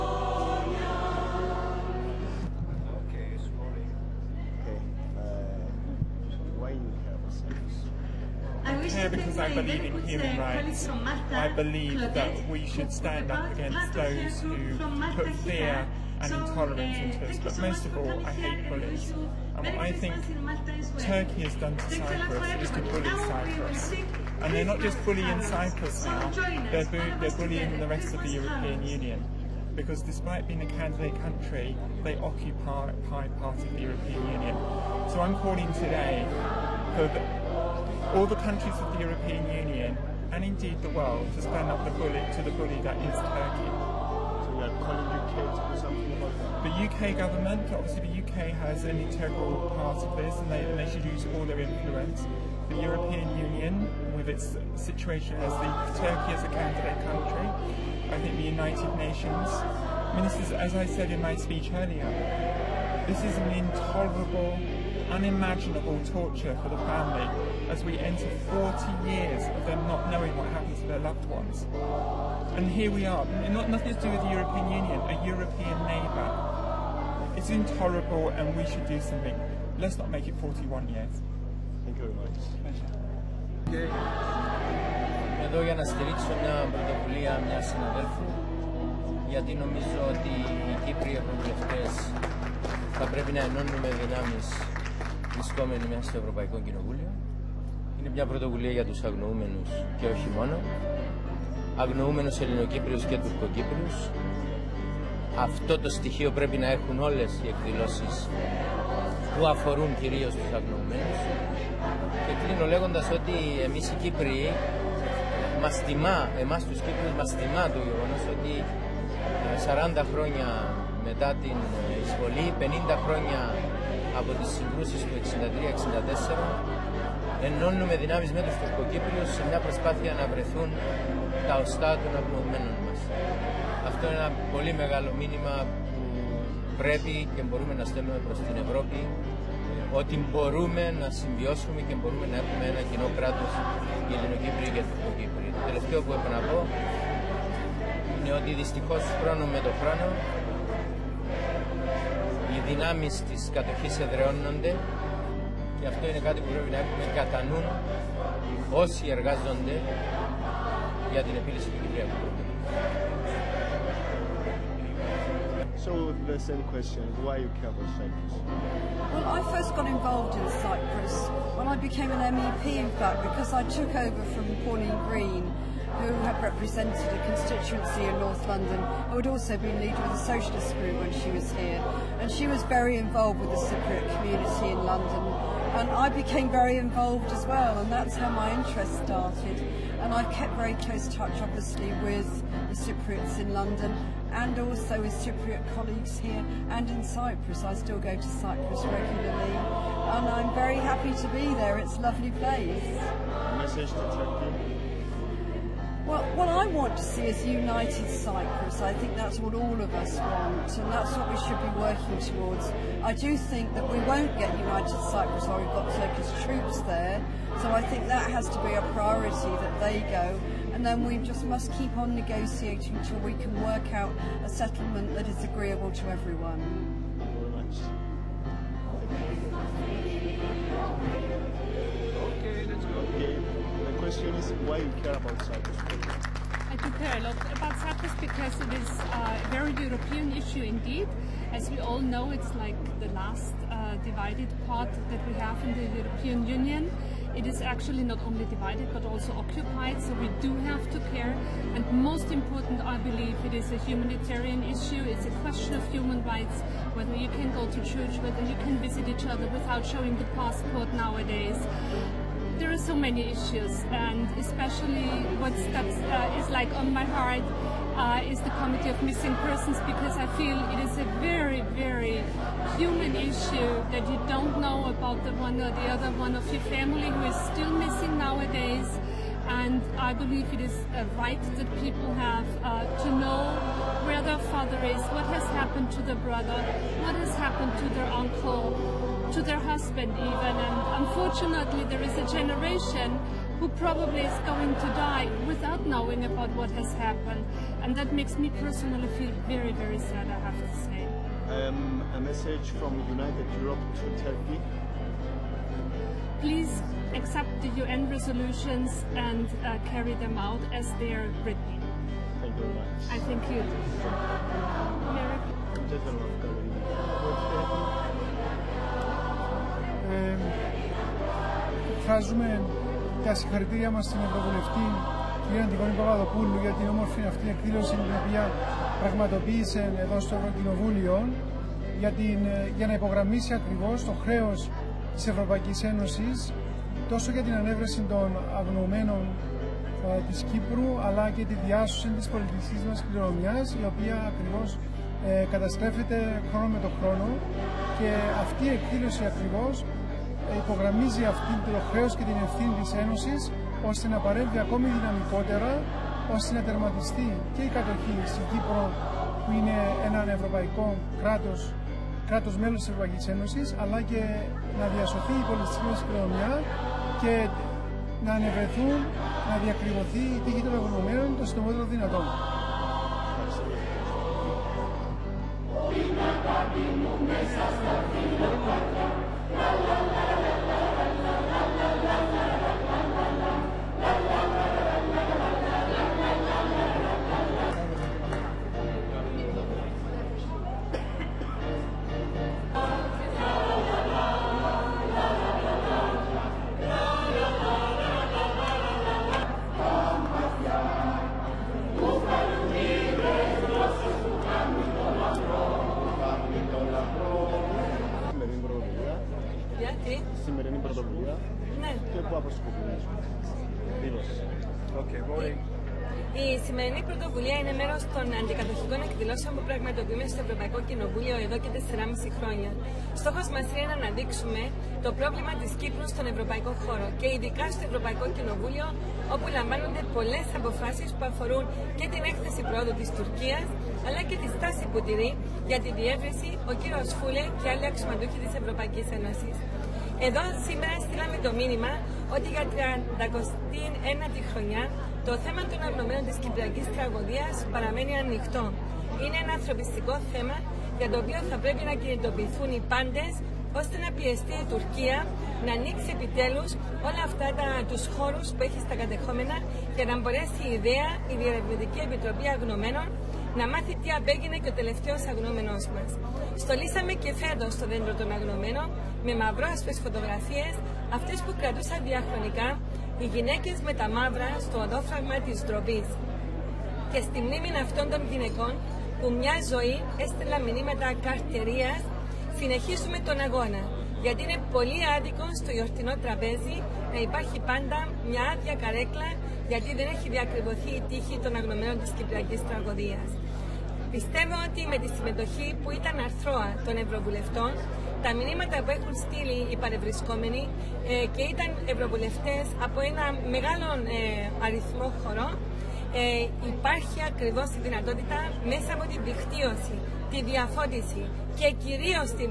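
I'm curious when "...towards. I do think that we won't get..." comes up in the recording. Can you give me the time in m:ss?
3:32.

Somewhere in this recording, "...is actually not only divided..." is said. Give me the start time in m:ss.
4:07.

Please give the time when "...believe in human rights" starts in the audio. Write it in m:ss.
0:09.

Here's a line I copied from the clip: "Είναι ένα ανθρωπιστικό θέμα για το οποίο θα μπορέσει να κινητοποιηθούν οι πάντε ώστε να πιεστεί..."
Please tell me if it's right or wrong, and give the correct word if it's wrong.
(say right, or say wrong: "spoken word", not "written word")
wrong: "πρέπει", not "μπορέσει".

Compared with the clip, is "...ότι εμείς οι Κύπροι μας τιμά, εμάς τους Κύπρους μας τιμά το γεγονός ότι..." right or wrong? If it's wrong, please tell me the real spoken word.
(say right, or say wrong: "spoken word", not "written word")
right.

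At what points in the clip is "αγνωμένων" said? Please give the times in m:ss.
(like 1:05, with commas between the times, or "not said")
2:12, 7:25, 7:42, 7:48, 8:11.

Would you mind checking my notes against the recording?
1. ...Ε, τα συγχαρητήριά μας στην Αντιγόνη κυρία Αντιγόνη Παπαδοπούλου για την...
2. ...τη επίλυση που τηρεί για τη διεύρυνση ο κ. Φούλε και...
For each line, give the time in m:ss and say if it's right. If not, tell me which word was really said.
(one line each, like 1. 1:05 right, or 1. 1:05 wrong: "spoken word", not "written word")
1. 5:20 wrong: "Ευρωβουλευτή", not "Αντιγόνη"
2. 7:14 wrong: "στάση", not "επίλυση".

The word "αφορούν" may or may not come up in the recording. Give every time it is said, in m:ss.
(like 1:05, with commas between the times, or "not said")
1:49, 7:11.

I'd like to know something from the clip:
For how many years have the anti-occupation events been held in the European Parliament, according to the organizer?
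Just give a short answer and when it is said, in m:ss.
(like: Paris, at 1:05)
4.5 years, at 7:01.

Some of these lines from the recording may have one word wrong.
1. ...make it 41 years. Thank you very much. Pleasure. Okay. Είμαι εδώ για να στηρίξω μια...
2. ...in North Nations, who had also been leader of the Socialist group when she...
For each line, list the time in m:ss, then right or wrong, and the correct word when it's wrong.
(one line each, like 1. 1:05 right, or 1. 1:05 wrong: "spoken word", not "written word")
1. 1:20 right
2. 2:58 wrong: "London", not "Nations".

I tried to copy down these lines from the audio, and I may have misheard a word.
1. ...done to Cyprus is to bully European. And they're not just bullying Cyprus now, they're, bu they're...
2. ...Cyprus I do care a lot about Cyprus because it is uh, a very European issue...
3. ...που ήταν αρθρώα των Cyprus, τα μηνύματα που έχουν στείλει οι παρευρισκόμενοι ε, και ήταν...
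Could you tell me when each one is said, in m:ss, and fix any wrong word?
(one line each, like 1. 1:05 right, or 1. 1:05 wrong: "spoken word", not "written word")
1. 0:21 wrong: "Cyprus", not "European"
2. 3:55 right
3. 8:15 wrong: "Ευρωβουλευτών", not "Cyprus".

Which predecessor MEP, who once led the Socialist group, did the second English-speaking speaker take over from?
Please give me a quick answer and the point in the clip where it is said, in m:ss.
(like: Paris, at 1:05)
Pauline Green, at 2:54.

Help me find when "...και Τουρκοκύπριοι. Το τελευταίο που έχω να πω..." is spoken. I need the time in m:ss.
2:24.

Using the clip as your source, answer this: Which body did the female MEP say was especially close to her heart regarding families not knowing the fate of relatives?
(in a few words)
Committee of Missing Persons.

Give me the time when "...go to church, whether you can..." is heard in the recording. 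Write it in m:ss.
4:17.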